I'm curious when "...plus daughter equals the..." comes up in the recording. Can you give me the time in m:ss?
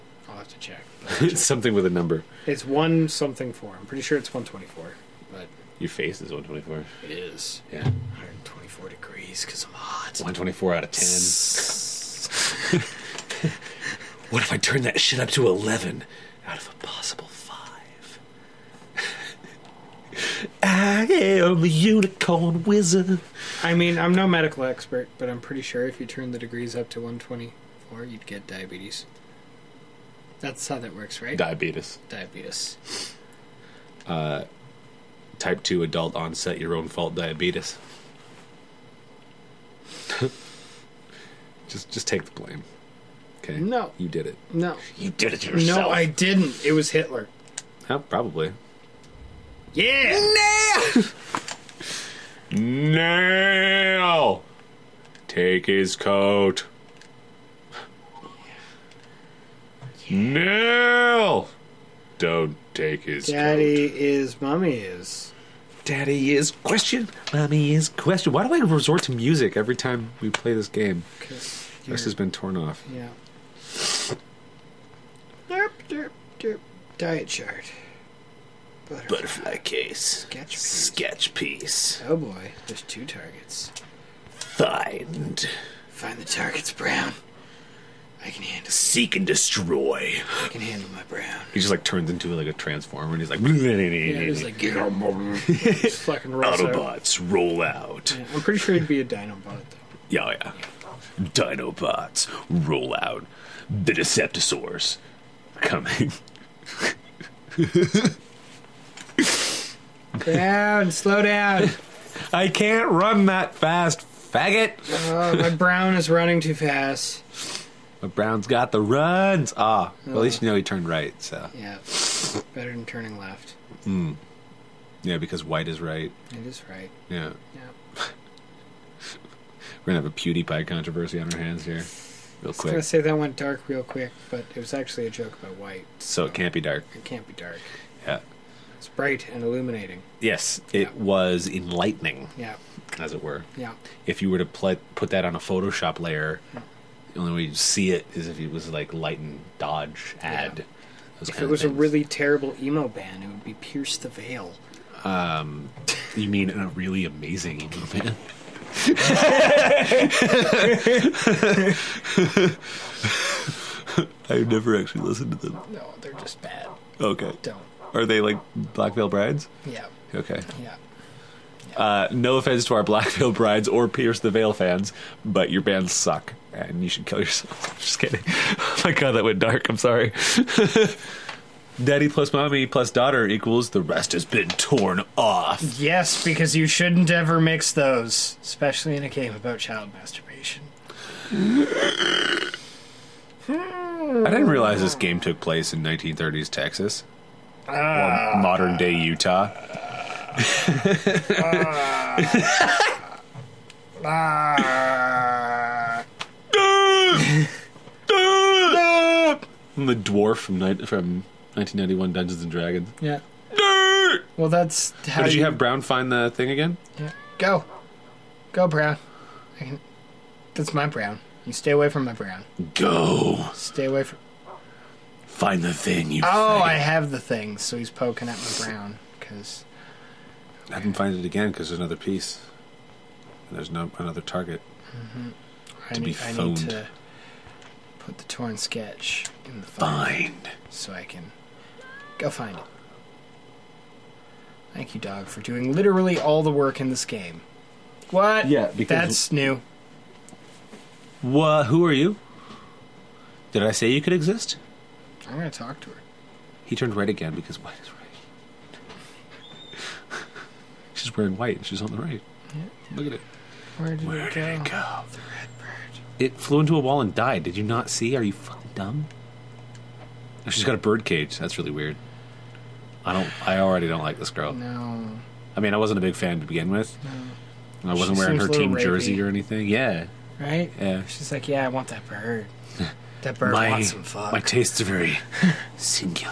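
3:02.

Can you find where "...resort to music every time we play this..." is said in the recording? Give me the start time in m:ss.
1:08.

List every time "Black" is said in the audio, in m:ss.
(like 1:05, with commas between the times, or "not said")
2:48, 2:52.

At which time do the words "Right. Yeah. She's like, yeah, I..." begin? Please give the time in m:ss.
4:40.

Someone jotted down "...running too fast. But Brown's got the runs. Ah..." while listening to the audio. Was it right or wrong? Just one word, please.
right.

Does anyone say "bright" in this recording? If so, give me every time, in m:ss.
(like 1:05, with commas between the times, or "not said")
2:18.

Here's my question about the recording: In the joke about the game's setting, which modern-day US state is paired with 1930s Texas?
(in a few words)
Utah.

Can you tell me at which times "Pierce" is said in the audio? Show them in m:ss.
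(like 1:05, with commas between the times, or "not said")
2:33, 2:53.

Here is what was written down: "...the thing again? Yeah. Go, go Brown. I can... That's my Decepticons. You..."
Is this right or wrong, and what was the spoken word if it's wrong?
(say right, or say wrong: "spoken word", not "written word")
wrong: "Brown", not "Decepticons".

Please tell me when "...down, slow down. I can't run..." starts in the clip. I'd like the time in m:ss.
1:50.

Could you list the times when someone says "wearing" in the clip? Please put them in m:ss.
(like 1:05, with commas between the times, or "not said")
4:21, 4:38.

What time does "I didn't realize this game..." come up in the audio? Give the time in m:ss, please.
3:13.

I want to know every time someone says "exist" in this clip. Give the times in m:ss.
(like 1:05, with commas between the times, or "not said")
4:14.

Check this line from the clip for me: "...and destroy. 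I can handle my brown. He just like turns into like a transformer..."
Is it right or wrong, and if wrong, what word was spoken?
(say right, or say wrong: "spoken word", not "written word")
right.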